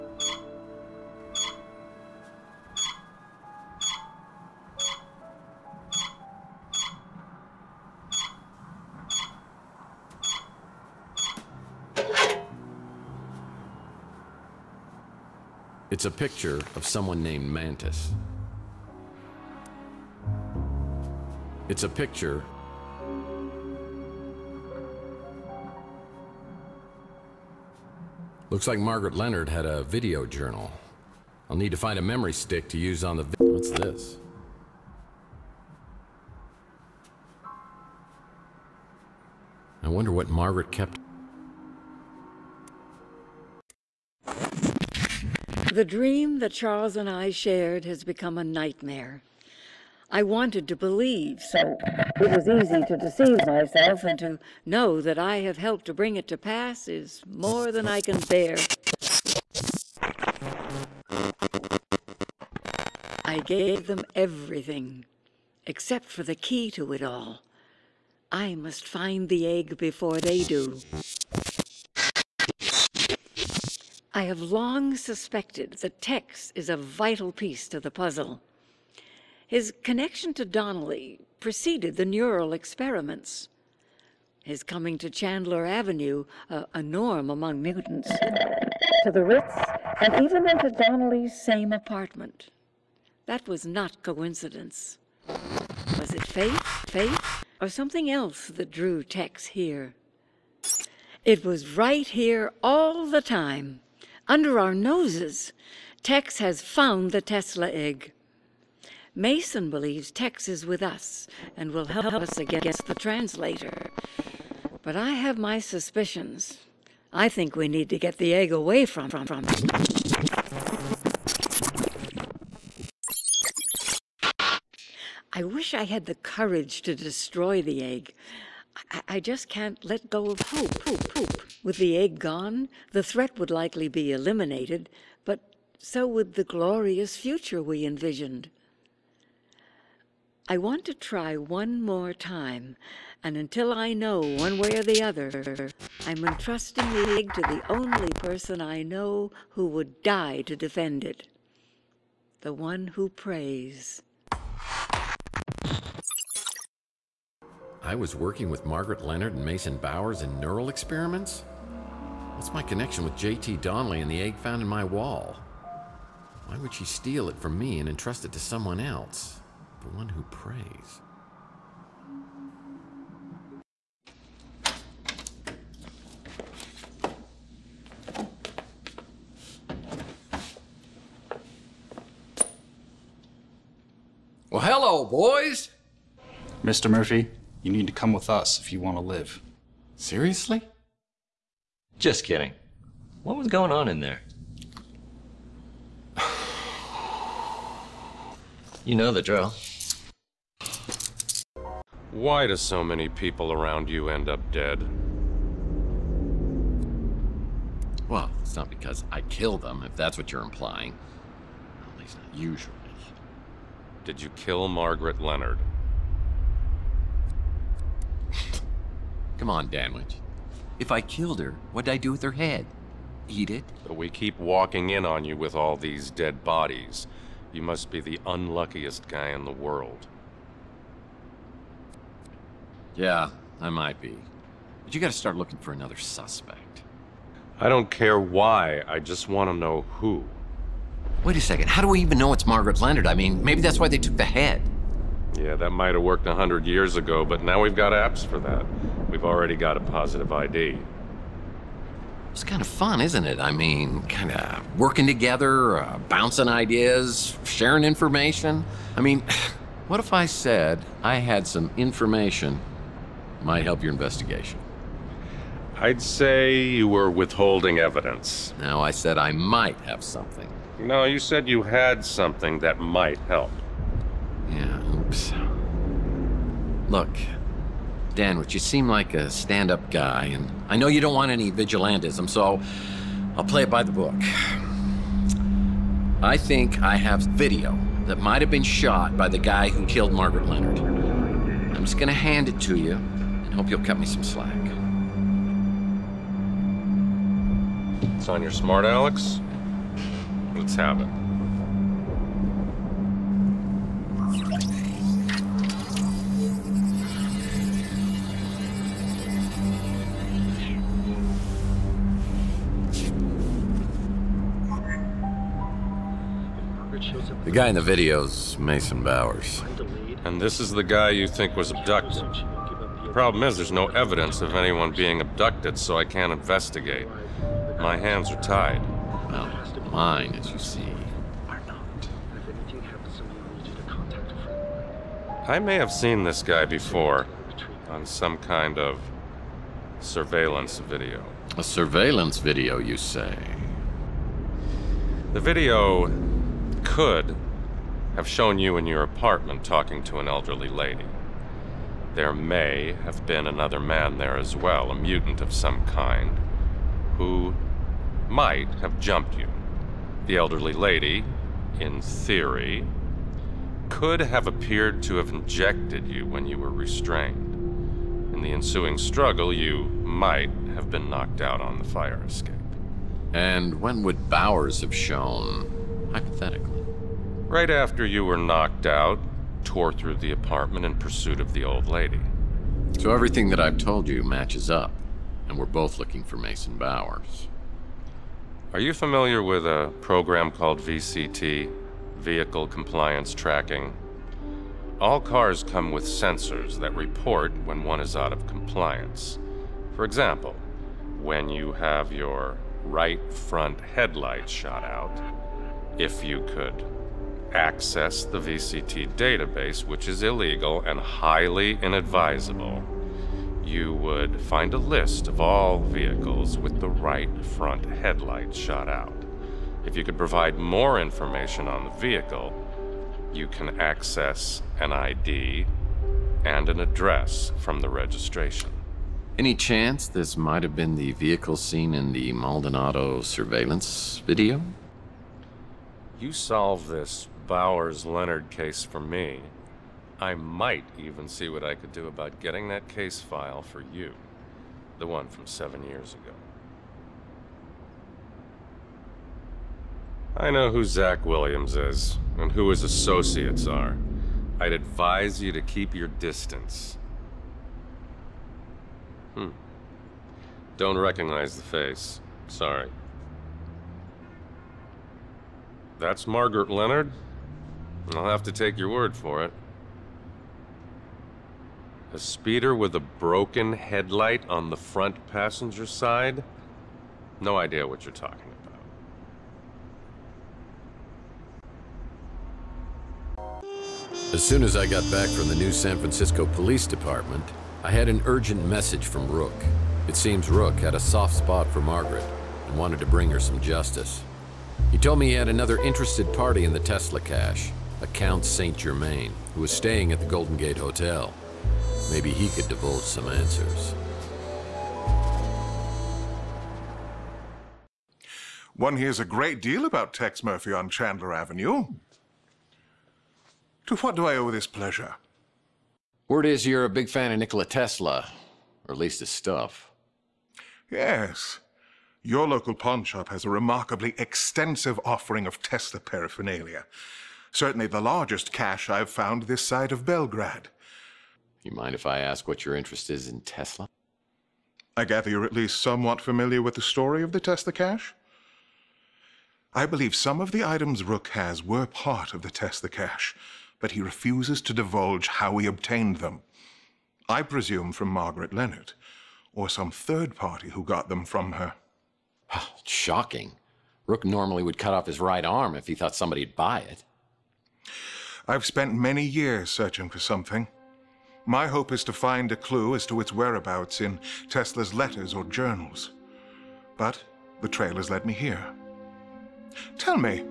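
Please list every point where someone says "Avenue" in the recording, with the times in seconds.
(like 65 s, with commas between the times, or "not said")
85 s, 511 s.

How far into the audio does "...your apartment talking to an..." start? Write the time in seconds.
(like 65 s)
348 s.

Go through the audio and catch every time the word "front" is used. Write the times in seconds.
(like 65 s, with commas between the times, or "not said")
403 s, 417 s, 474 s.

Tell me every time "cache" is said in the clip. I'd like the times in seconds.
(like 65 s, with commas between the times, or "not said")
497 s, 528 s, 537 s, 542 s.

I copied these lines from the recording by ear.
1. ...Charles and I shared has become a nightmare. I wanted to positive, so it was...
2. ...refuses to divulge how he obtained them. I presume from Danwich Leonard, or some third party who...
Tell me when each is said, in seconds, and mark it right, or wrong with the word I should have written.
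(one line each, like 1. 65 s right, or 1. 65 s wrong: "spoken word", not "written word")
1. 46 s wrong: "believe", not "positive"
2. 544 s wrong: "Margaret", not "Danwich".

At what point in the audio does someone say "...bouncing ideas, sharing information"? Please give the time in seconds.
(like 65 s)
256 s.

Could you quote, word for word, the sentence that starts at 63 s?
I gave them everything, except for the key to it all.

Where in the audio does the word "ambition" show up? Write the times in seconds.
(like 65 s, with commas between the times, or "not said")
not said.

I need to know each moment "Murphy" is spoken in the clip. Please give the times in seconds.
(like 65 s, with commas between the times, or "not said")
186 s, 510 s.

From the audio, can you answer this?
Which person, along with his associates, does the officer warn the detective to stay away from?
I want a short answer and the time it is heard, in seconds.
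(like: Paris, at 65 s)
Zach Williams, at 450 s.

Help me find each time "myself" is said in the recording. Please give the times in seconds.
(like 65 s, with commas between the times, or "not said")
53 s.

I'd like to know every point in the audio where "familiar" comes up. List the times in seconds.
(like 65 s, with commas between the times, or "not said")
388 s, 536 s.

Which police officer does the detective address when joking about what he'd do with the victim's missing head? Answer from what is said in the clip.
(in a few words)
Danwich.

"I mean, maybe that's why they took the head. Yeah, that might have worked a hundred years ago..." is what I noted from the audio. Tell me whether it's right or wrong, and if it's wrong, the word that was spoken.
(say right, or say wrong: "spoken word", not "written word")
right.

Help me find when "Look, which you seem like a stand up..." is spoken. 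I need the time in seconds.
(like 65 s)
276 s.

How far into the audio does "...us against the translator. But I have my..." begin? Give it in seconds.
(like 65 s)
112 s.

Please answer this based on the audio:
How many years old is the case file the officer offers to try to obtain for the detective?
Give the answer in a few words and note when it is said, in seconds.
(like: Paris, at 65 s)
7, at 445 s.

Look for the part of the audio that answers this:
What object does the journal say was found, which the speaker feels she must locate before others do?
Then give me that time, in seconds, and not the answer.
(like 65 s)
107 s.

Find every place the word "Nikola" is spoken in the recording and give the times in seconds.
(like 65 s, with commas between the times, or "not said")
517 s.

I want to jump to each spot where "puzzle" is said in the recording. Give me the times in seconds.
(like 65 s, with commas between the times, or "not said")
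77 s.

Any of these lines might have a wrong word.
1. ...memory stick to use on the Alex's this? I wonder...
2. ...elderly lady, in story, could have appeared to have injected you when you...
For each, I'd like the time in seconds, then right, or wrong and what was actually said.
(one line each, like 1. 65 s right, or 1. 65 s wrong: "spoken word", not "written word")
1. 32 s wrong: "What", not "Alex"
2. 360 s wrong: "theory", not "story".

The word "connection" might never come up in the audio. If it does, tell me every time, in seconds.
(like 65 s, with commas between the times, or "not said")
79 s, 162 s.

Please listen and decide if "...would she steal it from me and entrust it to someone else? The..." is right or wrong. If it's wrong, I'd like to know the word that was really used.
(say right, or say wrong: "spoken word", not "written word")
right.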